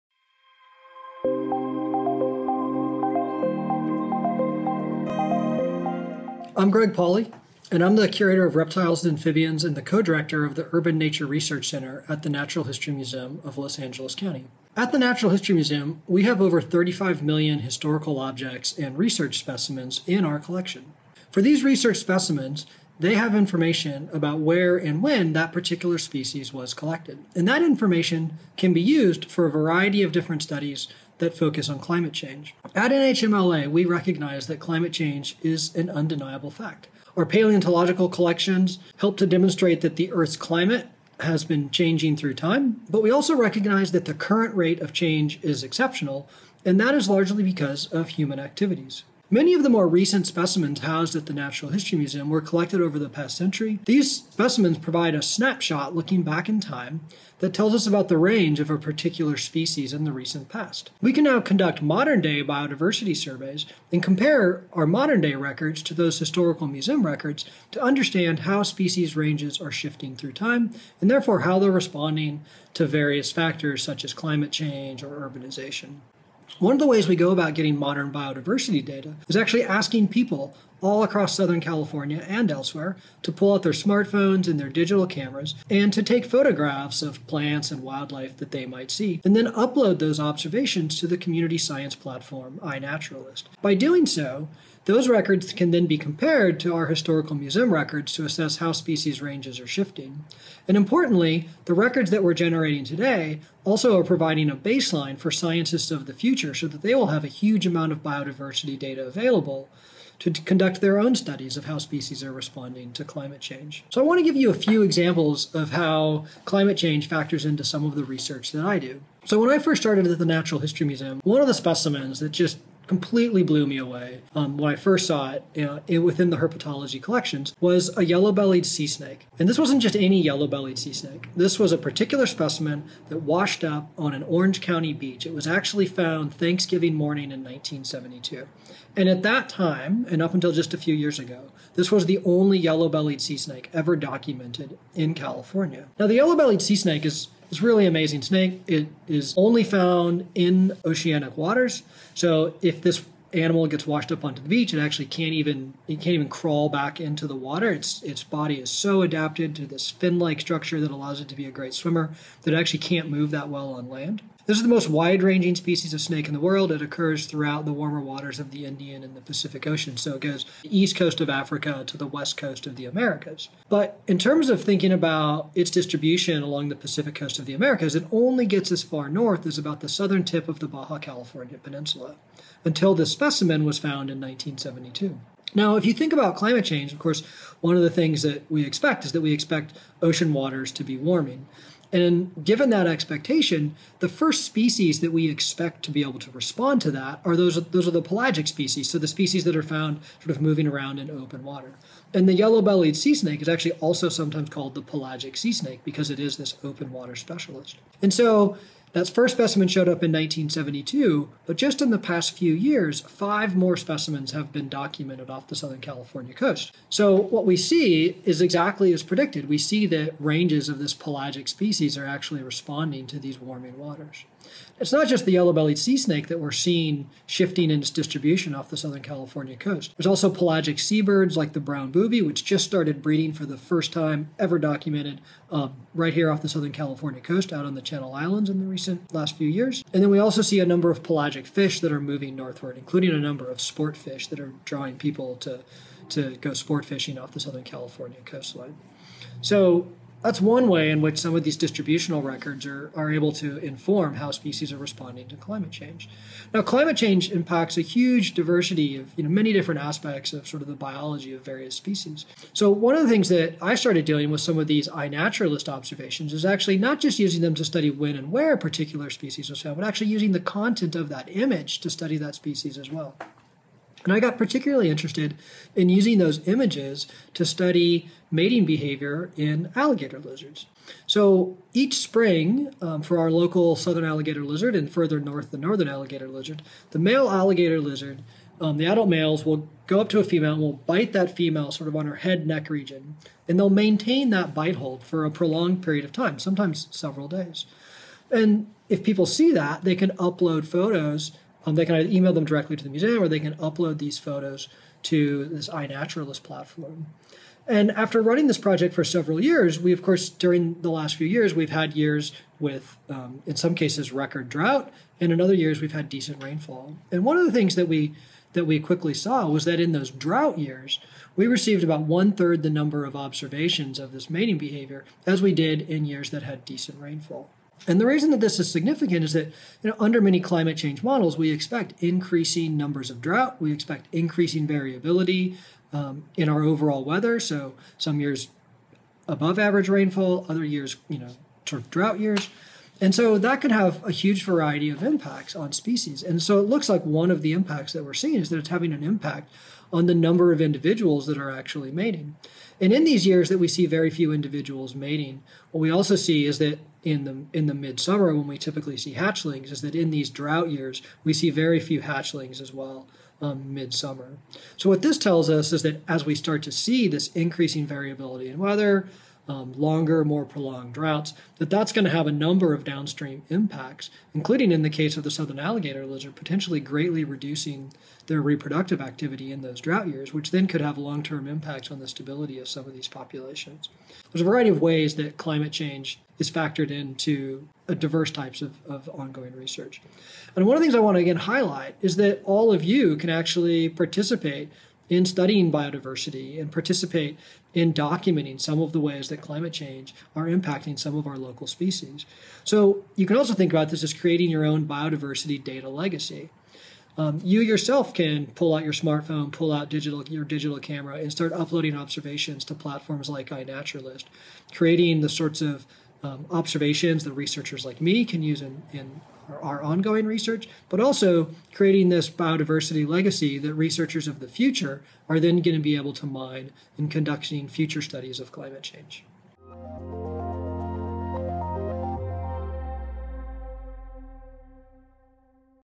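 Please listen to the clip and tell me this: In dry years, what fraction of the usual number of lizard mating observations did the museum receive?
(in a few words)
one third.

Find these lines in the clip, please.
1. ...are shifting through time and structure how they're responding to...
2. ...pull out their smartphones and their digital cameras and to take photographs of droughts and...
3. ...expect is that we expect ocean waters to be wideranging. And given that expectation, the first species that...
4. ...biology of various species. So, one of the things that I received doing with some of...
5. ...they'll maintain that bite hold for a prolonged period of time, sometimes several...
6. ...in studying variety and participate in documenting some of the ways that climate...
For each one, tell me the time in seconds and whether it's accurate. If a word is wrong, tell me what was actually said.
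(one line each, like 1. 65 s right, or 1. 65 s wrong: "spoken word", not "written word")
1. 69 s wrong: "therefore", not "structure"
2. 83 s wrong: "plants", not "droughts"
3. 188 s wrong: "warming", not "wideranging"
4. 260 s wrong: "started", not "received"
5. 293 s right
6. 395 s wrong: "biodiversity", not "variety".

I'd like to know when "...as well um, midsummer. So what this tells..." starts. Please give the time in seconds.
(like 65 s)
362 s.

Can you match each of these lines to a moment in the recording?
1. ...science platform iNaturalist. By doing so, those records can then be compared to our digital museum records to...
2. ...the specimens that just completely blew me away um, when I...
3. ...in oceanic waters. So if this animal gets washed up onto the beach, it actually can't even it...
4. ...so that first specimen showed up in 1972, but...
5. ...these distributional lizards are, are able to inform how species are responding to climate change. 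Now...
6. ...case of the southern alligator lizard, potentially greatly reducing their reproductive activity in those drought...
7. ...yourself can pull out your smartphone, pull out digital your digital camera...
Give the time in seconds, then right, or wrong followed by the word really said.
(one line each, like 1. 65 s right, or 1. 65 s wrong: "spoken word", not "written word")
1. 91 s wrong: "historical", not "digital"
2. 121 s right
3. 150 s right
4. 208 s right
5. 251 s wrong: "records", not "lizards"
6. 374 s right
7. 407 s right.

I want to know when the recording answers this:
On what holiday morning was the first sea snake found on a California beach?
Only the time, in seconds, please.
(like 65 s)
136 s.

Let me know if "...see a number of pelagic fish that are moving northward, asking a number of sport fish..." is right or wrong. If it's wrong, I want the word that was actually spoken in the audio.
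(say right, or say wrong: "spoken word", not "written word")
wrong: "including", not "asking".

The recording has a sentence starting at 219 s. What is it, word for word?
We see that ranges of this pelagic species are actually responding to these warming waters.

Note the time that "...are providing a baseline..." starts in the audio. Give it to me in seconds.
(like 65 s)
103 s.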